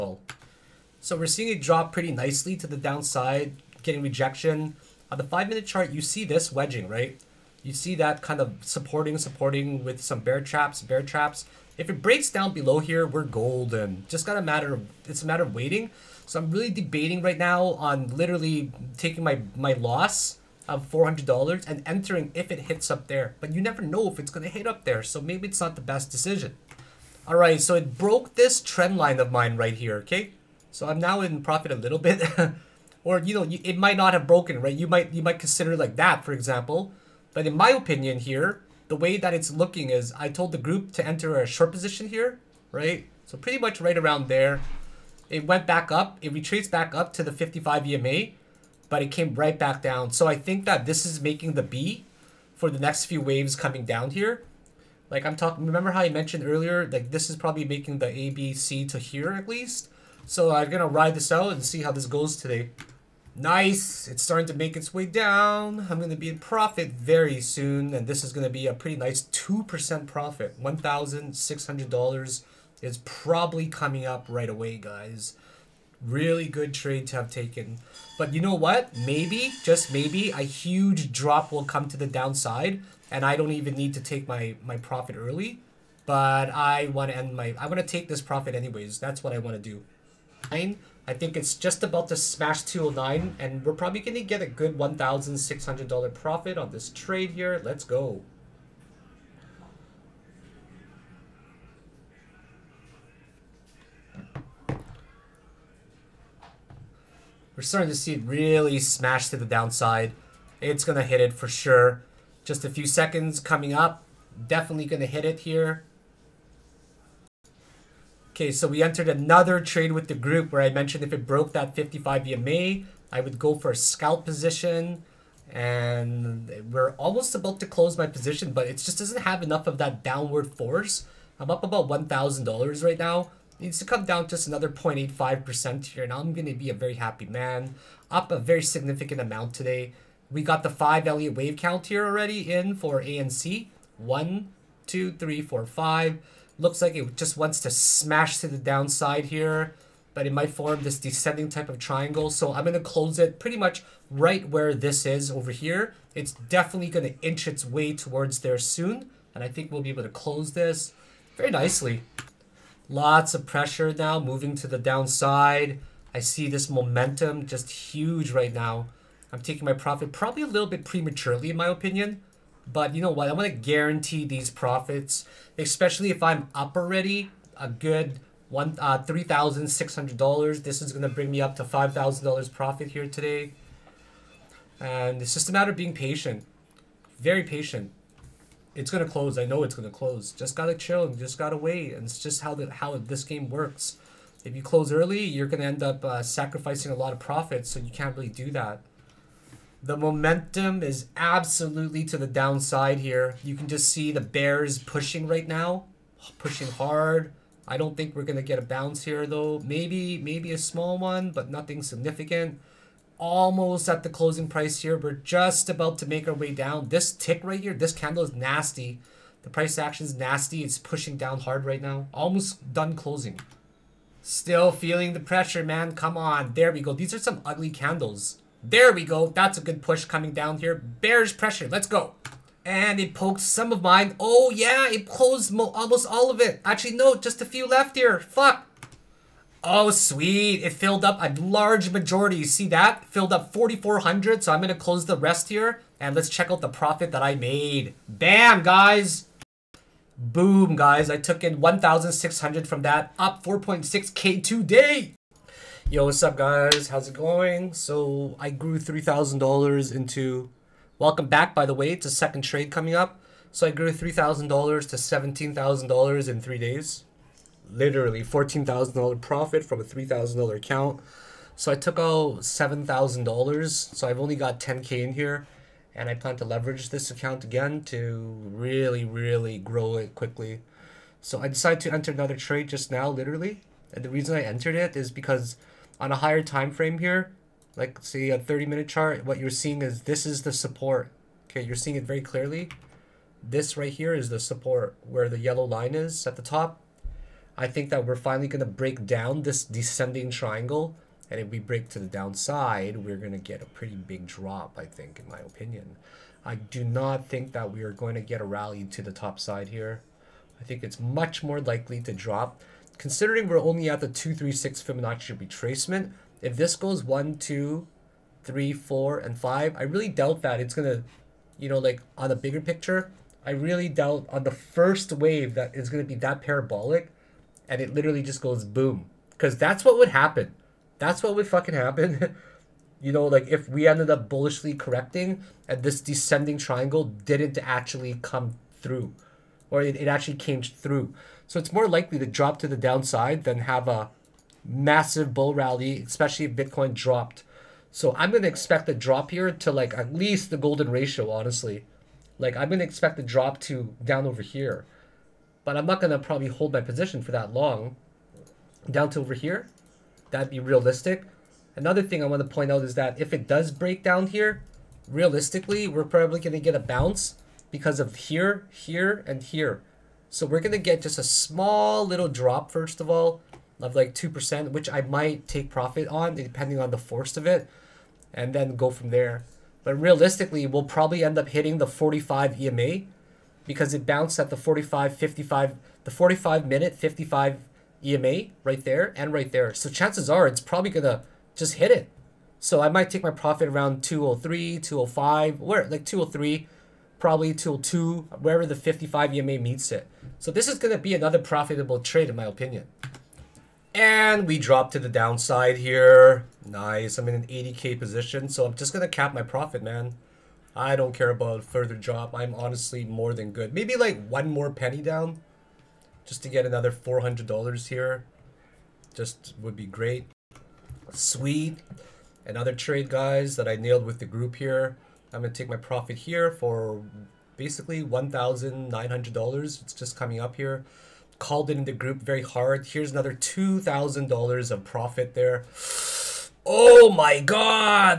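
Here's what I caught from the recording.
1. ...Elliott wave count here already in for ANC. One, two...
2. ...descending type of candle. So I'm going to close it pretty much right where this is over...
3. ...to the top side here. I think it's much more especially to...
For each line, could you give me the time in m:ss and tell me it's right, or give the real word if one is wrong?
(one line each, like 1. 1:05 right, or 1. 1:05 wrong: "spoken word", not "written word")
1. 2:21 right
2. 2:30 wrong: "triangle", not "candle"
3. 5:08 wrong: "likely", not "especially".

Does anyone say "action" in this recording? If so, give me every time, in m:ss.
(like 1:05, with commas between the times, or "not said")
3:39.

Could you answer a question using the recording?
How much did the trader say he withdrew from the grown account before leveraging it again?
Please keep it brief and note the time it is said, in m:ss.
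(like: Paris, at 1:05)
$7,000, at 4:32.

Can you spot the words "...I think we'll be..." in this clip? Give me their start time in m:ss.
2:39.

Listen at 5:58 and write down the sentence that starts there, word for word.
Down to over here, that'd be realistic.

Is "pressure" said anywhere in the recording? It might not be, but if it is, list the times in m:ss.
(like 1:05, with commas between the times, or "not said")
2:43, 3:45, 3:51.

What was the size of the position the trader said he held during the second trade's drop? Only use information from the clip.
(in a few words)
80k.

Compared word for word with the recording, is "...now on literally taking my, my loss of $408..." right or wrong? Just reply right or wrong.
wrong.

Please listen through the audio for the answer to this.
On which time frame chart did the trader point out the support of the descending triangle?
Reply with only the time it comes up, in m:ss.
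4:48.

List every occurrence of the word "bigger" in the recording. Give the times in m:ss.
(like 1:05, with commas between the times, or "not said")
5:22.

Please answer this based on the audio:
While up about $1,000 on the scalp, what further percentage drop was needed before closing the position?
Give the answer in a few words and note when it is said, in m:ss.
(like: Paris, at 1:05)
0.85%, at 2:14.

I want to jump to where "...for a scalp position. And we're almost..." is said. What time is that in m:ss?
2:03.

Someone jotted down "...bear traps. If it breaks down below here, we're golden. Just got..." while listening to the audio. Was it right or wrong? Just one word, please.
right.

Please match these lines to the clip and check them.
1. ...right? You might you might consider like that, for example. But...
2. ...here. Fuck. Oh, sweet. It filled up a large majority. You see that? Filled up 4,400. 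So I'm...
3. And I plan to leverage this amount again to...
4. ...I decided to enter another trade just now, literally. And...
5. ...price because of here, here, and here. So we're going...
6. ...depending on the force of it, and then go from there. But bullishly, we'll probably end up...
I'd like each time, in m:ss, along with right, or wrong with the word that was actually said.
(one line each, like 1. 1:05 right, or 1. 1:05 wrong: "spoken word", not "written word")
1. 0:34 right
2. 3:57 right
3. 4:35 wrong: "account", not "amount"
4. 4:41 right
5. 6:06 wrong: "bounce", not "price"
6. 6:16 wrong: "realistically", not "bullishly".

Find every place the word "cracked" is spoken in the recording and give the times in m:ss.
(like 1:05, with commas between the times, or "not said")
not said.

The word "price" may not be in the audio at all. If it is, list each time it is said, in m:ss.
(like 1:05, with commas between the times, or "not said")
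3:34, 3:39.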